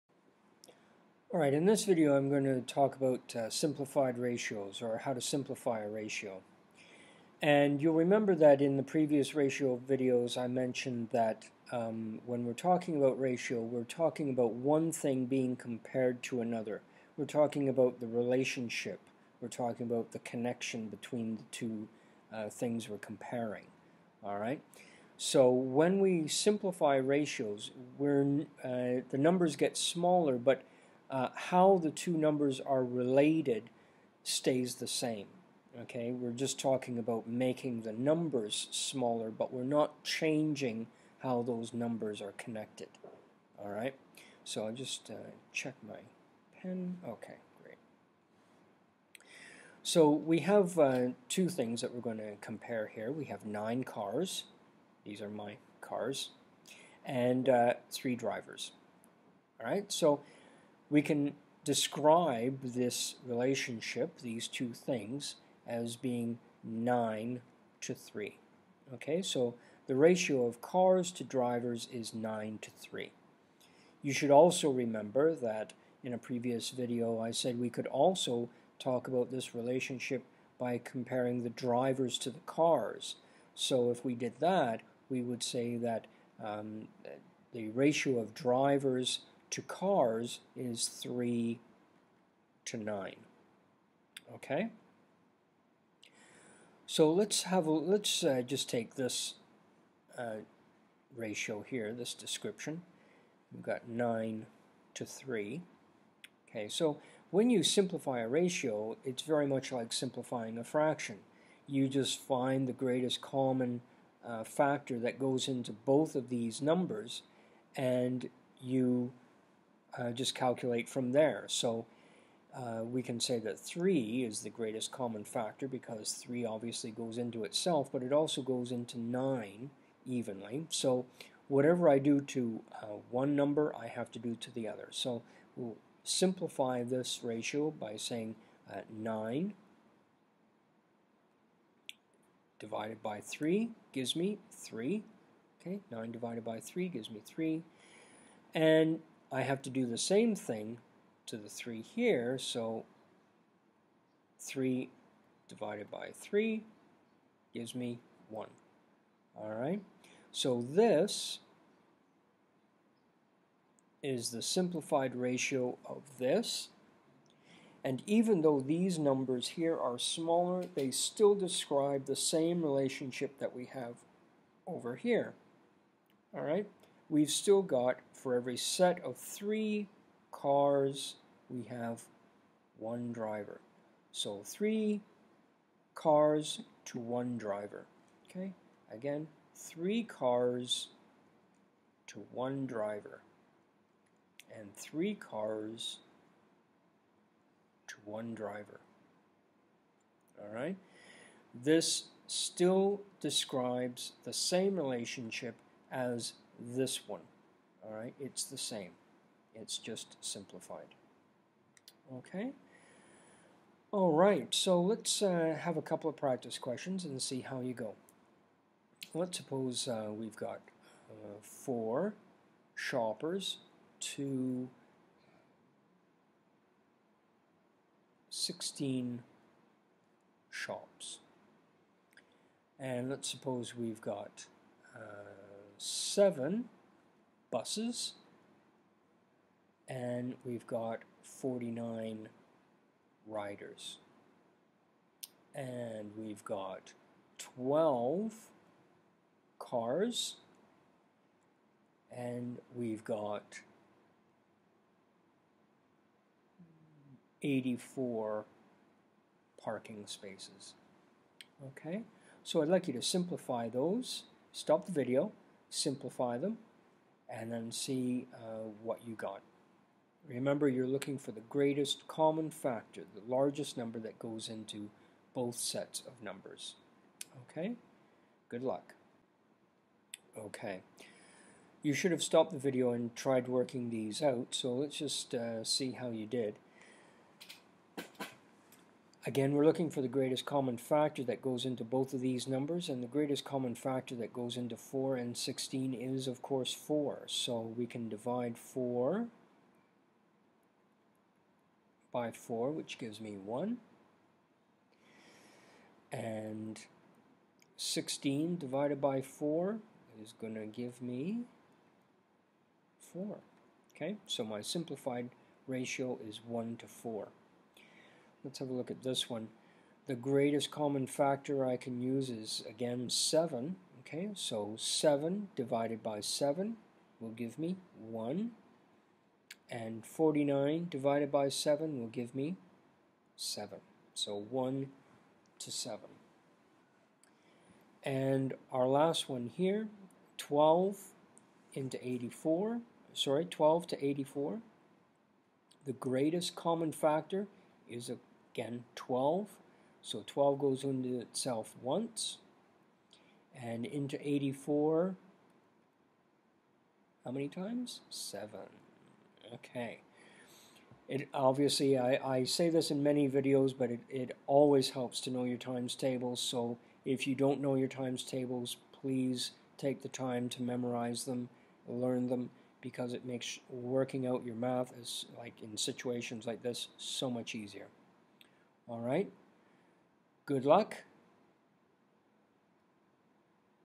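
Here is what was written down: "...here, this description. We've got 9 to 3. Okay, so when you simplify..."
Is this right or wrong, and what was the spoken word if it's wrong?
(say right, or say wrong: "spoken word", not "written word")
right.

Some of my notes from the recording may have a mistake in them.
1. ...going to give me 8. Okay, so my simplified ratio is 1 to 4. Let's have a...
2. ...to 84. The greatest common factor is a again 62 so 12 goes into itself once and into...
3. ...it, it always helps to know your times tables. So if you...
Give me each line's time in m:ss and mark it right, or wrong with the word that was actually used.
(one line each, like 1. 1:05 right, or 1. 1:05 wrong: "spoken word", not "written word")
1. 5:10 wrong: "4", not "8"
2. 5:43 wrong: "12", not "62"
3. 6:03 right.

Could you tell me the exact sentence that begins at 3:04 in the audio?
So three cars to one driver.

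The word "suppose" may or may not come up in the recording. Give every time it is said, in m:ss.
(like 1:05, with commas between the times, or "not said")
3:39, 3:53.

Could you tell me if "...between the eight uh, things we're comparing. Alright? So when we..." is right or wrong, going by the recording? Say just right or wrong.
wrong.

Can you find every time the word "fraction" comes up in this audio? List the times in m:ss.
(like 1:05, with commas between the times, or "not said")
1:50.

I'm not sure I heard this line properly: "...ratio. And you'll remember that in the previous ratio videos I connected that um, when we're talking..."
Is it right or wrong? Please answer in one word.
wrong.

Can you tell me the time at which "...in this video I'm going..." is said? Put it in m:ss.
0:01.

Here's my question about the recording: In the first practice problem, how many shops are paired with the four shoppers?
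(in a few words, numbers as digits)
16.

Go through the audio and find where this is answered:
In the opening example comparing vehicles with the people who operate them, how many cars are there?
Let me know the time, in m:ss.
0:53.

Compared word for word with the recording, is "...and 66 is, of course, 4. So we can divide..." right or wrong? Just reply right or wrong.
wrong.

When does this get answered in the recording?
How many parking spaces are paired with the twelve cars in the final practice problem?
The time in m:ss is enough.
4:17.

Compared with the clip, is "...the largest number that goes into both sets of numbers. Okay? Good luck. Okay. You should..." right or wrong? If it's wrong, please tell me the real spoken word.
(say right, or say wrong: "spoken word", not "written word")
right.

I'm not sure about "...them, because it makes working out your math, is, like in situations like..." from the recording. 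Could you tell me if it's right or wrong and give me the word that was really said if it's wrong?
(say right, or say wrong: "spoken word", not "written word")
right.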